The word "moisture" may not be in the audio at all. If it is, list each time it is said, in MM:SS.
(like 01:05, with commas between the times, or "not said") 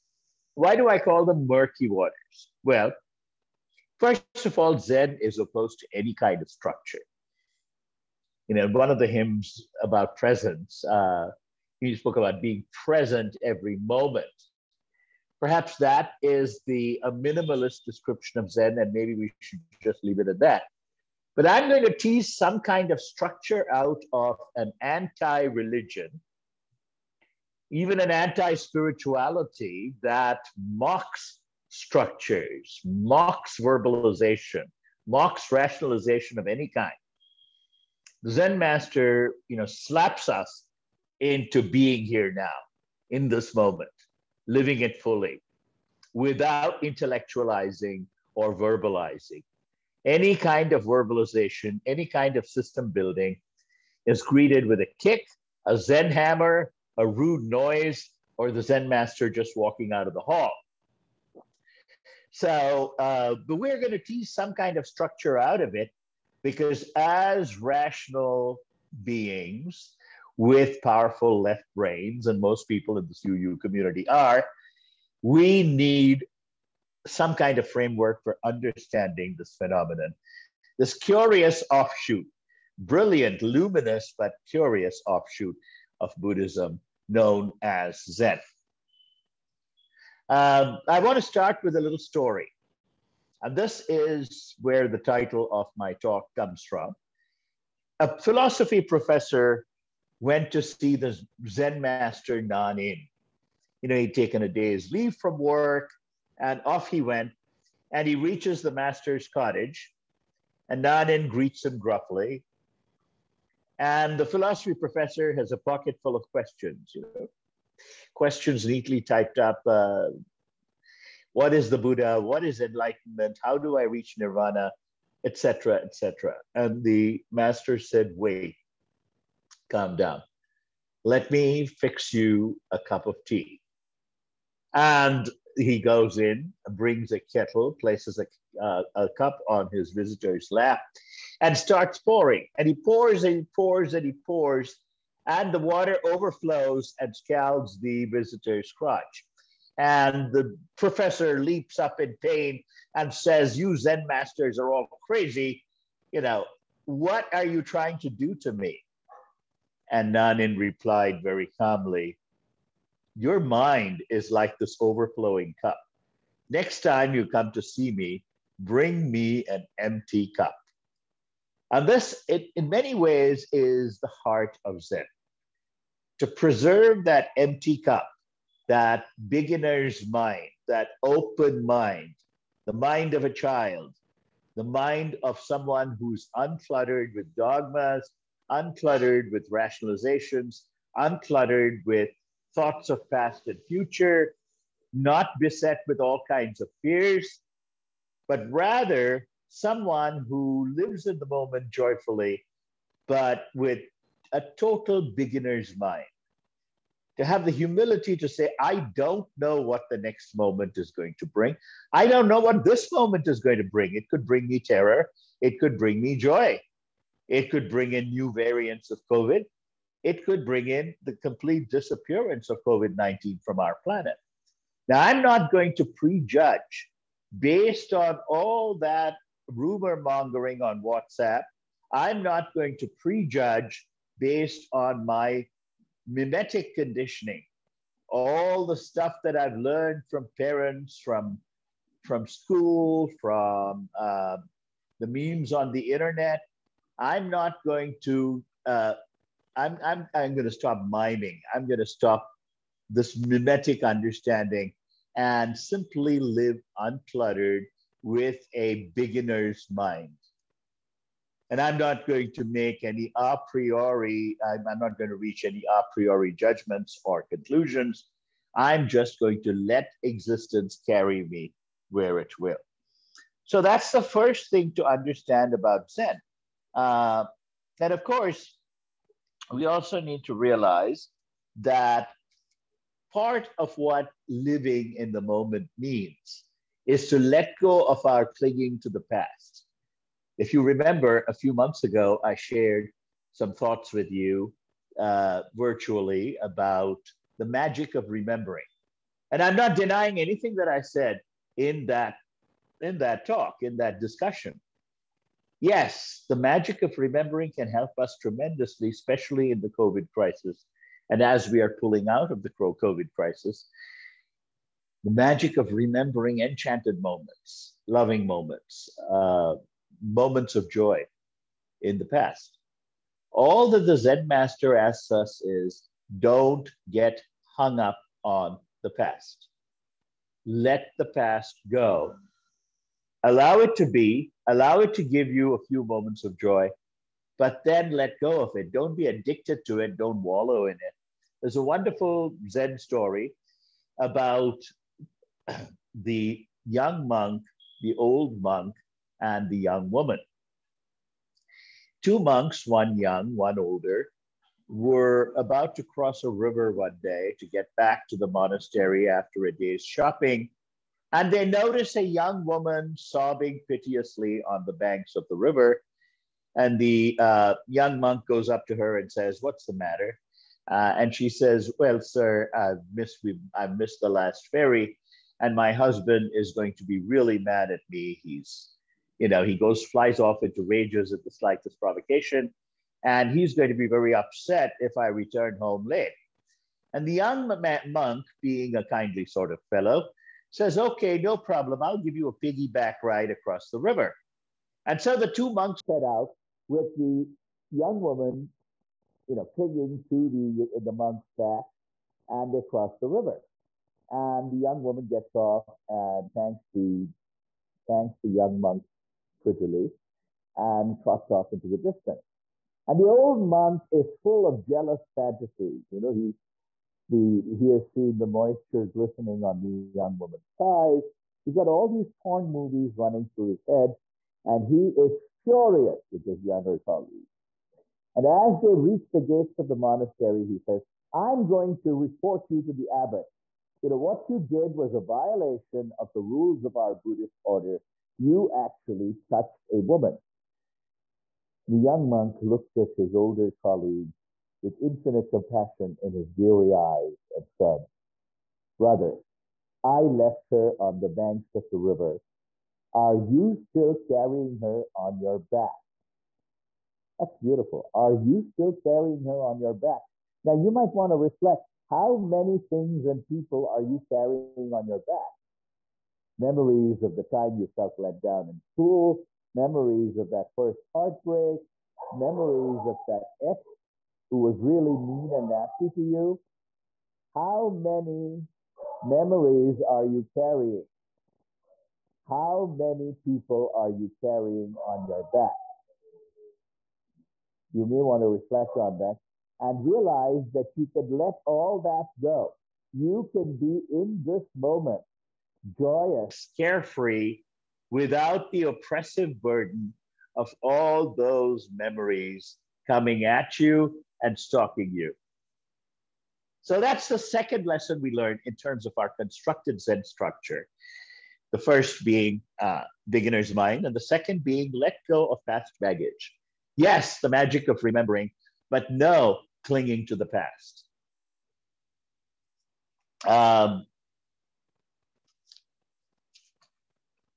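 06:58.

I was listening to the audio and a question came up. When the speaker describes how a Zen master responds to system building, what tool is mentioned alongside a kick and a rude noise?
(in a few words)
a Zen hammer.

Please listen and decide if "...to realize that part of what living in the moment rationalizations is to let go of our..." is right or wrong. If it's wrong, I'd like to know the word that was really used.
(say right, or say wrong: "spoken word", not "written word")
wrong: "means", not "rationalizations".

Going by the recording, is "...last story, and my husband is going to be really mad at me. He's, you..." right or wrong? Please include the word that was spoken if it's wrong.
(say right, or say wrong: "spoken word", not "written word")
wrong: "ferry", not "story".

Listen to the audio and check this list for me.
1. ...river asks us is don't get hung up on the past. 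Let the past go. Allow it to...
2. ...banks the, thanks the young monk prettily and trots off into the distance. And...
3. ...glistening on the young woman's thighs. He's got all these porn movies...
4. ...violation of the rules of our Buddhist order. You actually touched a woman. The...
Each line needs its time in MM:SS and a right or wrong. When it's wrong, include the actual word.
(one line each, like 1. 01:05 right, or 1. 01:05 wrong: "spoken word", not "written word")
1. 05:24 wrong: "master", not "river"
2. 06:46 wrong: "thanks", not "banks"
3. 06:58 right
4. 07:14 right.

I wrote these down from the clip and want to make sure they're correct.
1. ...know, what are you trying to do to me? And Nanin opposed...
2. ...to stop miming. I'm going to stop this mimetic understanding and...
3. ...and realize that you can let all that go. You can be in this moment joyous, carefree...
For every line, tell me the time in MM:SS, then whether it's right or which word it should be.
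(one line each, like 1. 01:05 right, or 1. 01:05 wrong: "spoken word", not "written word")
1. 02:36 wrong: "replied", not "opposed"
2. 04:10 right
3. 08:09 right.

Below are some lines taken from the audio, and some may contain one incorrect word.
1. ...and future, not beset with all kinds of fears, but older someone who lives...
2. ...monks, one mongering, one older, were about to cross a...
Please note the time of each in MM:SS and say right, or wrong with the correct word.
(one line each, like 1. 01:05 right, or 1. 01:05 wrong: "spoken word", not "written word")
1. 03:13 wrong: "rather", not "older"
2. 05:52 wrong: "young", not "mongering".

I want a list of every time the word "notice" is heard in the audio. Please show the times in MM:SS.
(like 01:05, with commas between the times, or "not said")
06:01.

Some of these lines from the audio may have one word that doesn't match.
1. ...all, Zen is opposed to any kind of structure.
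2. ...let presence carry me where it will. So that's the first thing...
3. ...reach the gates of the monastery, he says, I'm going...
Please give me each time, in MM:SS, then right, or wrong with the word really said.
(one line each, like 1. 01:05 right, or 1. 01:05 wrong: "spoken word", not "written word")
1. 00:04 right
2. 04:29 wrong: "existence", not "presence"
3. 07:08 right.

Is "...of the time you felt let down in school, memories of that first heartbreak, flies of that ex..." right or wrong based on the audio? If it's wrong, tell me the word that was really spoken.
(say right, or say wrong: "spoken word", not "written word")
wrong: "memories", not "flies".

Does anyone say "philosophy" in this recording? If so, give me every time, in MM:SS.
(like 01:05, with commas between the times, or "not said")
01:38, 01:54.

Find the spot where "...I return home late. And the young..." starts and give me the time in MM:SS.
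06:24.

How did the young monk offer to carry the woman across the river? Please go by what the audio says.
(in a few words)
a piggyback ride.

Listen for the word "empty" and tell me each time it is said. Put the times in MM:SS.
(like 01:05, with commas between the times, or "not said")
02:49, 02:57.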